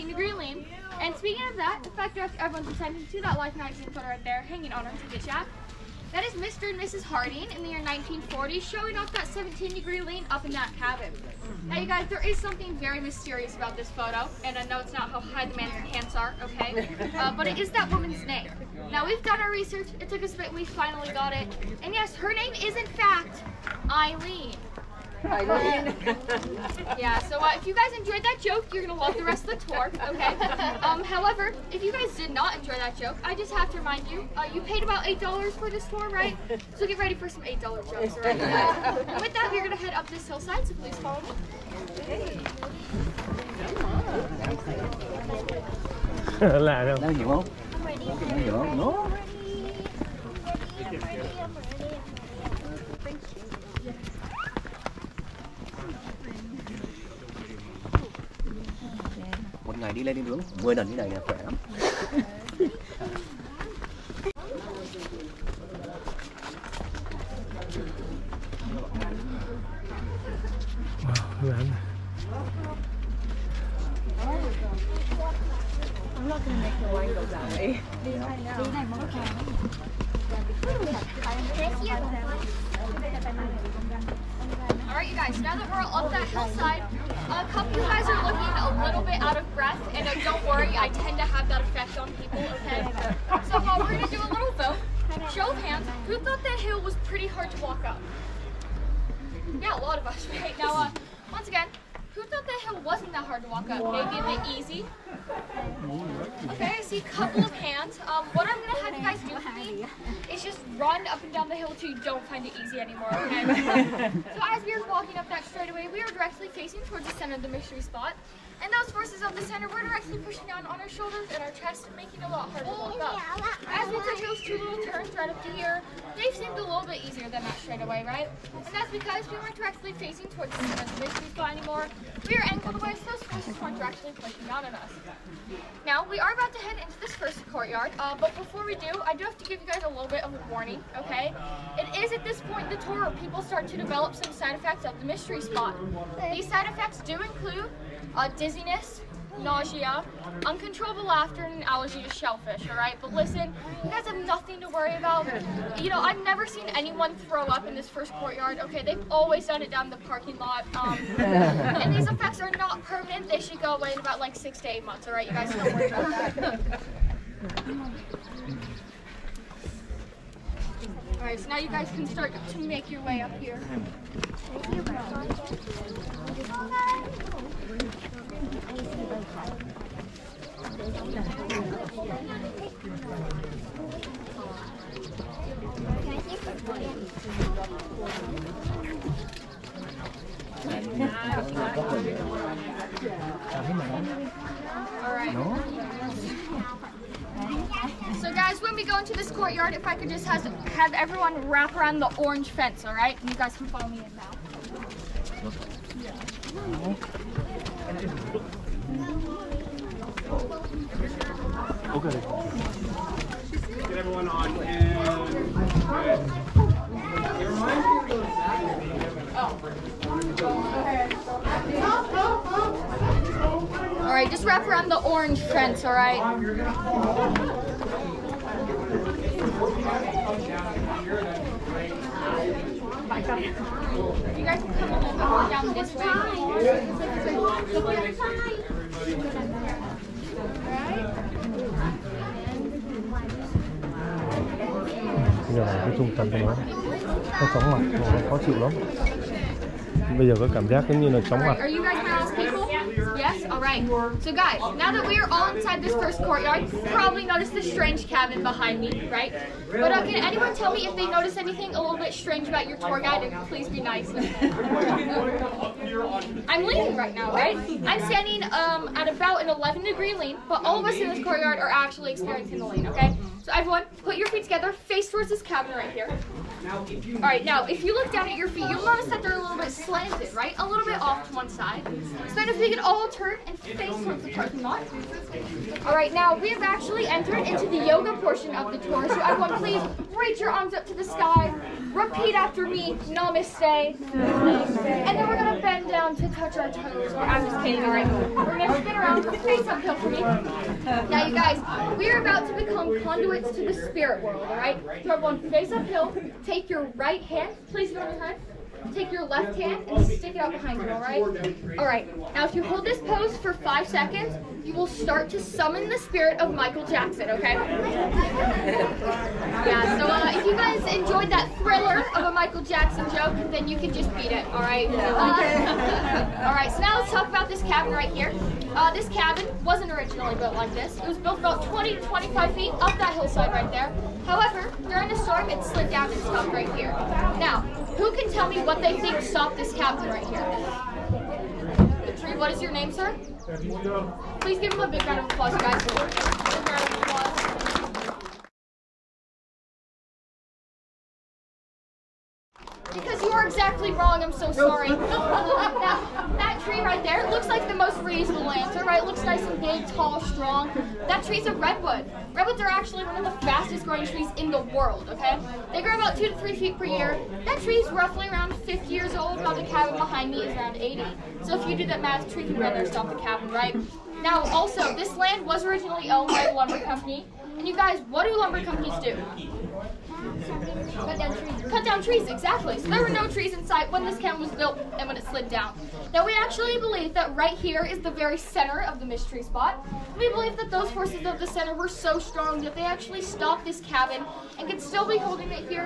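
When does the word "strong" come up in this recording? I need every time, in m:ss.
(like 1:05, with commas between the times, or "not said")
6:00, 6:32.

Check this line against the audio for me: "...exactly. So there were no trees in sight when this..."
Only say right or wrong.
right.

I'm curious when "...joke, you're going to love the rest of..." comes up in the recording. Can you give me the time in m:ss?
0:28.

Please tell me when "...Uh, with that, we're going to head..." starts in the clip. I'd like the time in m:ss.
0:39.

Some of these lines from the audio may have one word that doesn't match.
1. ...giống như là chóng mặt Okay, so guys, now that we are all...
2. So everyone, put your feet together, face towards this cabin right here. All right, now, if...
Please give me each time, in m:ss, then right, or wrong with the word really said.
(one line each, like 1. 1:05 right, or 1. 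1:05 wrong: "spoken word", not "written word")
1. 4:10 wrong: "Alright", not "Okay"
2. 4:33 right.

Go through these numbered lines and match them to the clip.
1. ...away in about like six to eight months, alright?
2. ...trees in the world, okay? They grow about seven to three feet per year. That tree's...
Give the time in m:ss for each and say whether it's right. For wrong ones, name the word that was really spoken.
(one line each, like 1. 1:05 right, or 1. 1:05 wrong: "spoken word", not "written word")
1. 2:43 right
2. 6:04 wrong: "two", not "seven".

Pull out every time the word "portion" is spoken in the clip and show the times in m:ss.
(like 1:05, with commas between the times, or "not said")
4:48.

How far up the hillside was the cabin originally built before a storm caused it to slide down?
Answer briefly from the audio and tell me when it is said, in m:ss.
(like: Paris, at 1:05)
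20 to 25 feet, at 5:31.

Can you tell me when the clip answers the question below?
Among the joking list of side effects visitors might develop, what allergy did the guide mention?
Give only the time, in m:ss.
2:31.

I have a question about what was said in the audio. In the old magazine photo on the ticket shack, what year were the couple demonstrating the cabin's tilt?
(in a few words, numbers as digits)
1940.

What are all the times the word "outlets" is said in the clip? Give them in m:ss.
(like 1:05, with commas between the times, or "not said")
not said.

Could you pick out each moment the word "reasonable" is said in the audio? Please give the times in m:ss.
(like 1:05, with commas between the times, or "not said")
5:57.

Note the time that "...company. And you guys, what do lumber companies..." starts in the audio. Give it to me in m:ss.
6:16.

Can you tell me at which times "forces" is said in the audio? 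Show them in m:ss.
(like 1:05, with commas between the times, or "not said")
1:58, 2:13, 6:30.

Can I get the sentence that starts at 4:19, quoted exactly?
But uh, can anyone tell me if they noticed anything a little bit strange about your tour guide?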